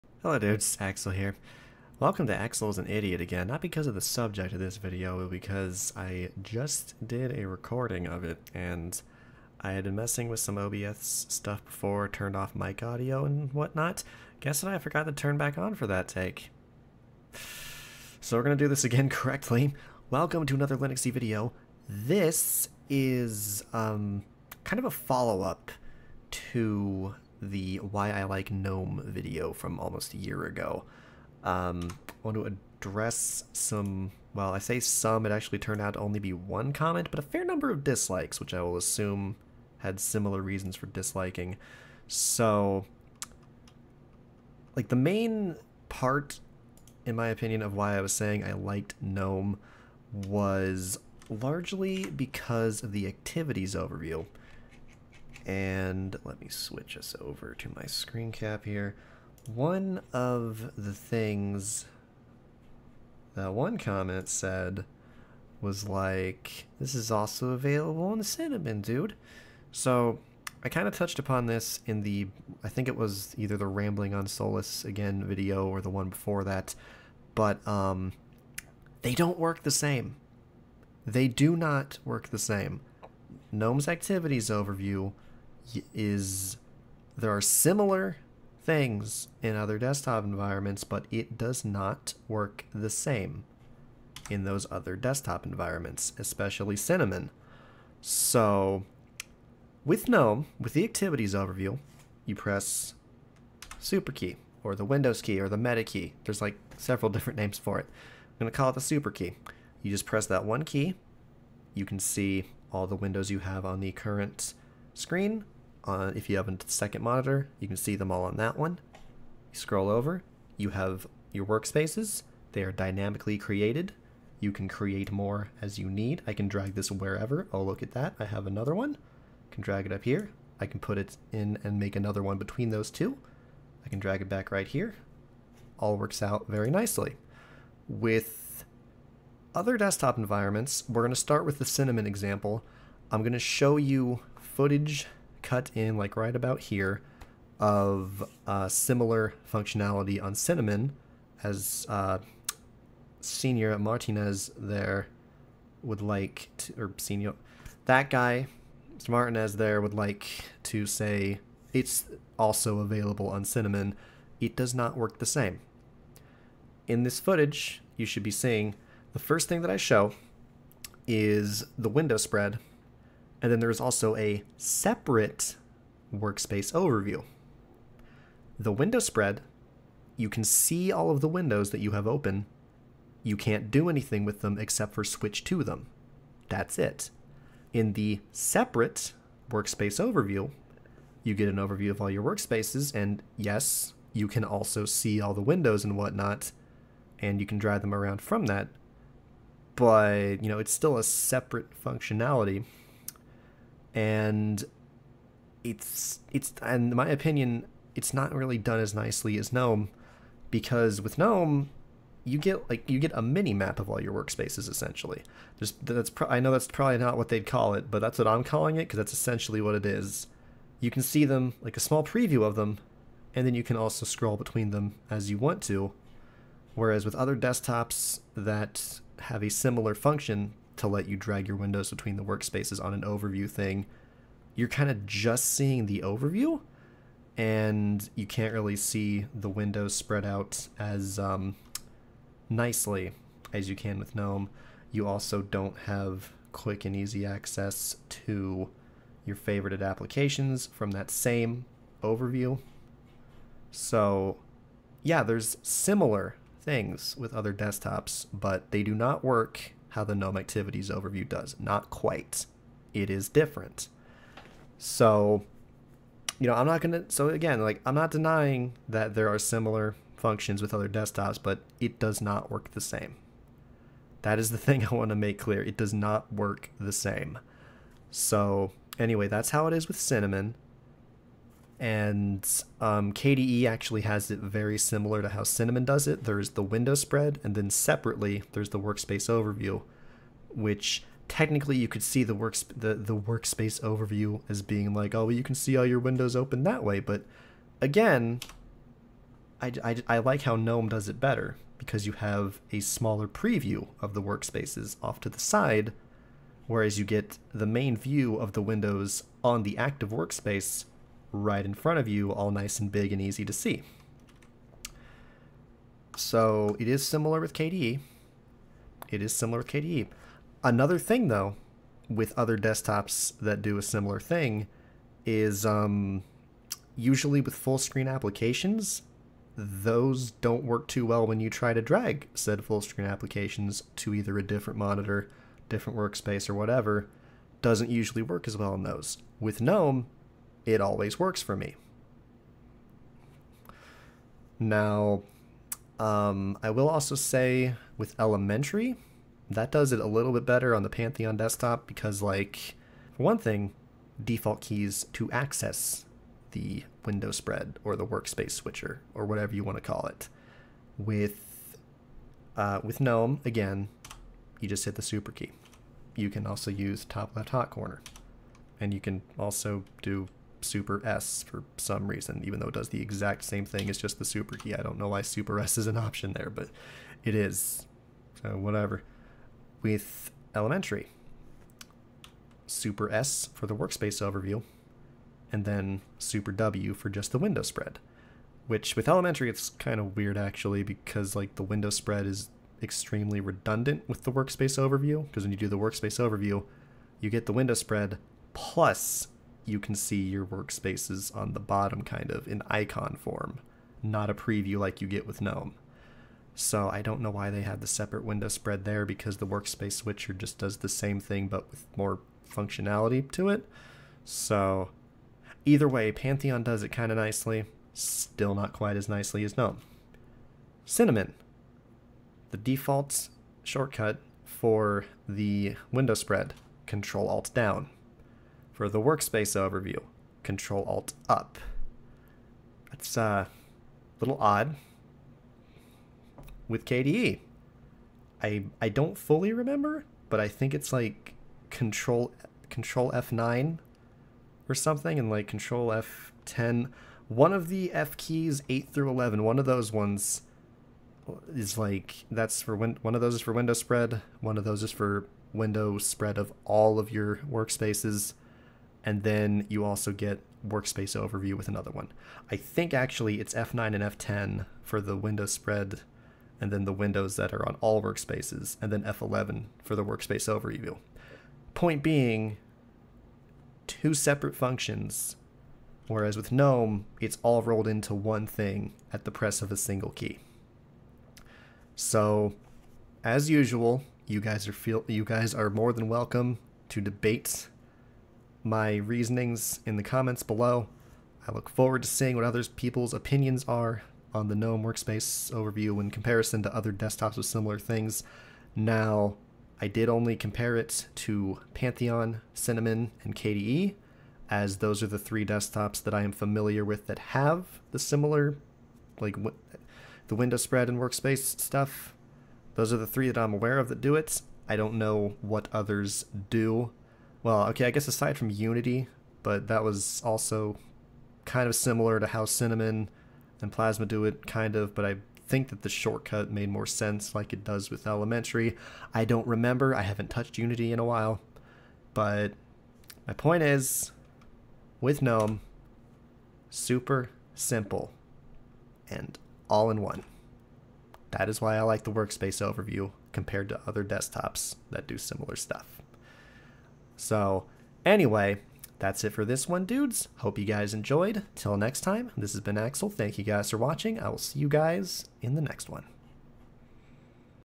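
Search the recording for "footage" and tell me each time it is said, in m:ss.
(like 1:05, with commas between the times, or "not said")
2:24, 2:47.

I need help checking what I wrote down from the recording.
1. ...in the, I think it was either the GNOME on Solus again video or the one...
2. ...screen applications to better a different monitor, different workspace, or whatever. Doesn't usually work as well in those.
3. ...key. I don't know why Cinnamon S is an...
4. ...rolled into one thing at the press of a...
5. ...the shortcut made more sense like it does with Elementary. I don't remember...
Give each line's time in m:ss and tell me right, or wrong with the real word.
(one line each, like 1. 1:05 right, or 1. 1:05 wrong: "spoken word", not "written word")
1. 1:11 wrong: "Rambling", not "GNOME"
2. 5:32 wrong: "either", not "better"
3. 6:14 wrong: "Super", not "Cinnamon"
4. 7:57 right
5. 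8:45 right.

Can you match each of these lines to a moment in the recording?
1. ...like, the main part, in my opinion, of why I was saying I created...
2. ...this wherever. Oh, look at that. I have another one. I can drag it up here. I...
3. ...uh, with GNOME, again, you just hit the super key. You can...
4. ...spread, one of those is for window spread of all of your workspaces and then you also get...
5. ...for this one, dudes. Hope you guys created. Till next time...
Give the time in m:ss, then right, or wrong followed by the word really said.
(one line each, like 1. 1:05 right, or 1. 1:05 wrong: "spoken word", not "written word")
1. 0:44 wrong: "liked", not "created"
2. 2:06 right
3. 6:02 right
4. 7:33 right
5. 9:09 wrong: "enjoyed", not "created".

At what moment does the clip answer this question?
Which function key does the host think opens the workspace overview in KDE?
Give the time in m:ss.
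7:49.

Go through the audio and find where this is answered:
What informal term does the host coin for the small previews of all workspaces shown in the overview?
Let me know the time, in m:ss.
3:33.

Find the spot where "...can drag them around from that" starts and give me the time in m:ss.
3:17.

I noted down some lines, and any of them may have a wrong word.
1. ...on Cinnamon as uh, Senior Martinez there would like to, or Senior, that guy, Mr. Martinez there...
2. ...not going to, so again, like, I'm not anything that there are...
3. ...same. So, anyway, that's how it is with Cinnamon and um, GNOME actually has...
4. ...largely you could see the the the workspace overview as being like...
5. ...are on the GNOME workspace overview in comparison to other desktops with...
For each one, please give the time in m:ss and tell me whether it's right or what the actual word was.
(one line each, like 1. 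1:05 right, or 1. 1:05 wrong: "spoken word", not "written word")
1. 2:30 right
2. 4:26 wrong: "denying", not "anything"
3. 4:36 wrong: "KDE", not "GNOME"
4. 4:51 wrong: "technically", not "largely"
5. 8:13 right.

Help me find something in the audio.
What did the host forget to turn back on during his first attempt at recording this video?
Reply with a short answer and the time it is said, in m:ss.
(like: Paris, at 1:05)
Mic audio, at 0:12.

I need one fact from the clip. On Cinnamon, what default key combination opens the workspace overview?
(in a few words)
Control Alt Up.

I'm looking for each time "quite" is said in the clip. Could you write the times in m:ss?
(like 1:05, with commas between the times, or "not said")
4:21, 6:58.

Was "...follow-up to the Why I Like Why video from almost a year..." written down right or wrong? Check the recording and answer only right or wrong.
wrong.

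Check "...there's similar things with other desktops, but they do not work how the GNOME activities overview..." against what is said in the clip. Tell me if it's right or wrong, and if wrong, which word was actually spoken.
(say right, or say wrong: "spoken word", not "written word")
right.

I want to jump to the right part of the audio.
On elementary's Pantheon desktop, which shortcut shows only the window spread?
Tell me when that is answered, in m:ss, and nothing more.
6:26.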